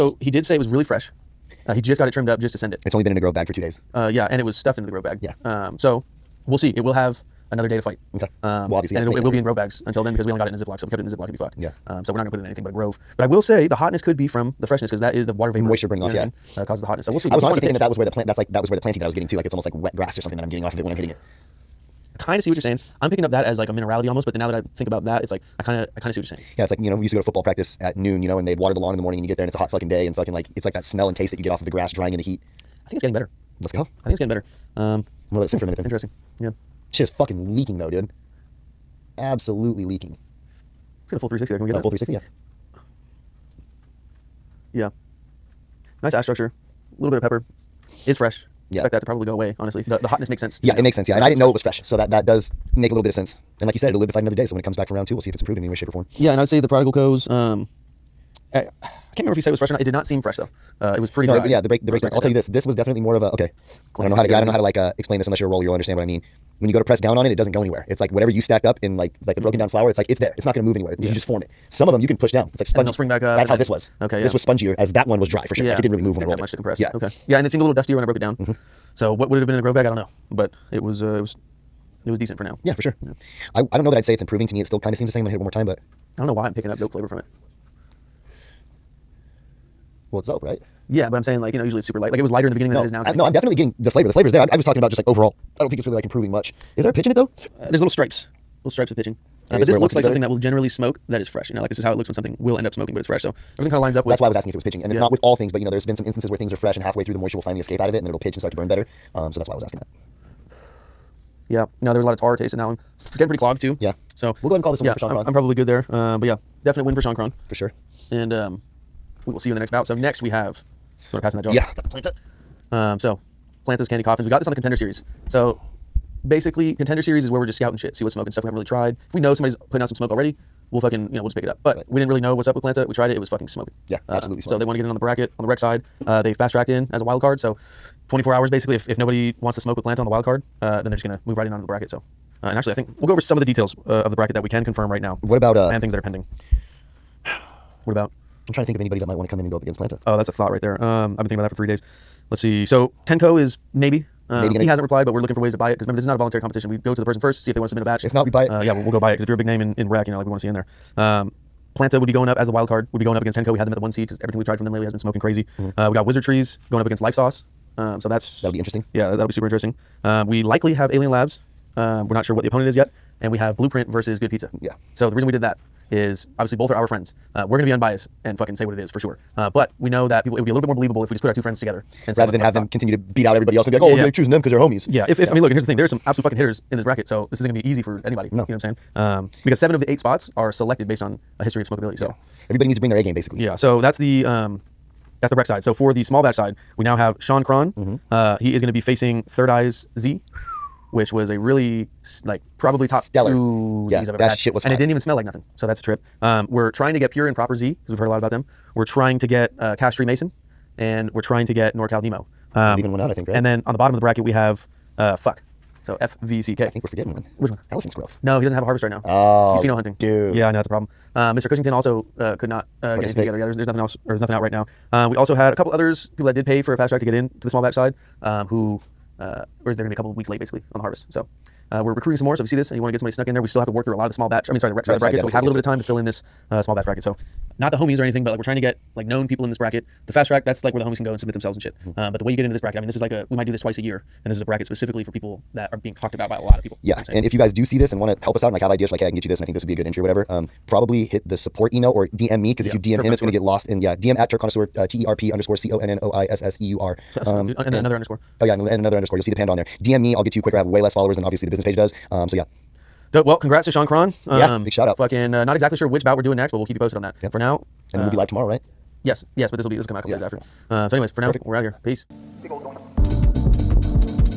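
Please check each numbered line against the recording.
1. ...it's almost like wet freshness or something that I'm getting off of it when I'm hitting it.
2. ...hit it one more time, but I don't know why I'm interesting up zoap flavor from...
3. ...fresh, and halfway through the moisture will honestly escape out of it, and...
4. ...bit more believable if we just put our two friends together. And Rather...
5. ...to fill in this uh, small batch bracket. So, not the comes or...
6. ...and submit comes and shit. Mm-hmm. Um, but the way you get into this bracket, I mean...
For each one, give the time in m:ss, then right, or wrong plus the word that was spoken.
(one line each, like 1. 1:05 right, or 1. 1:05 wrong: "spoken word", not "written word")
1. 0:19 wrong: "grass", not "freshness"
2. 1:25 wrong: "picking", not "interesting"
3. 1:46 wrong: "finally", not "honestly"
4. 3:00 right
5. 3:55 wrong: "homies", not "comes"
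6. 4:01 wrong: "themselves", not "comes".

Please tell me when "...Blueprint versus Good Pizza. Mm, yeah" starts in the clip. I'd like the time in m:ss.
2:53.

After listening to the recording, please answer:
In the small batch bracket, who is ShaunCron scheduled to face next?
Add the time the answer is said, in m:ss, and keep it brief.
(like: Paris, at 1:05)
Third Eyes Z, at 3:19.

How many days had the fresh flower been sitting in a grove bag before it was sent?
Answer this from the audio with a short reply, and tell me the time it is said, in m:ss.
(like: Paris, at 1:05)
2 days, at 0:03.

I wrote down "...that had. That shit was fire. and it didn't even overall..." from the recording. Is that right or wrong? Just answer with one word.
wrong.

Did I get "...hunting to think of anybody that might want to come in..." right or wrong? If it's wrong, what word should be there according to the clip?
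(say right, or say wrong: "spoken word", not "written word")
wrong: "trying", not "hunting".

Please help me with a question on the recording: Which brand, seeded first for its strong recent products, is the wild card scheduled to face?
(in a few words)
Henko.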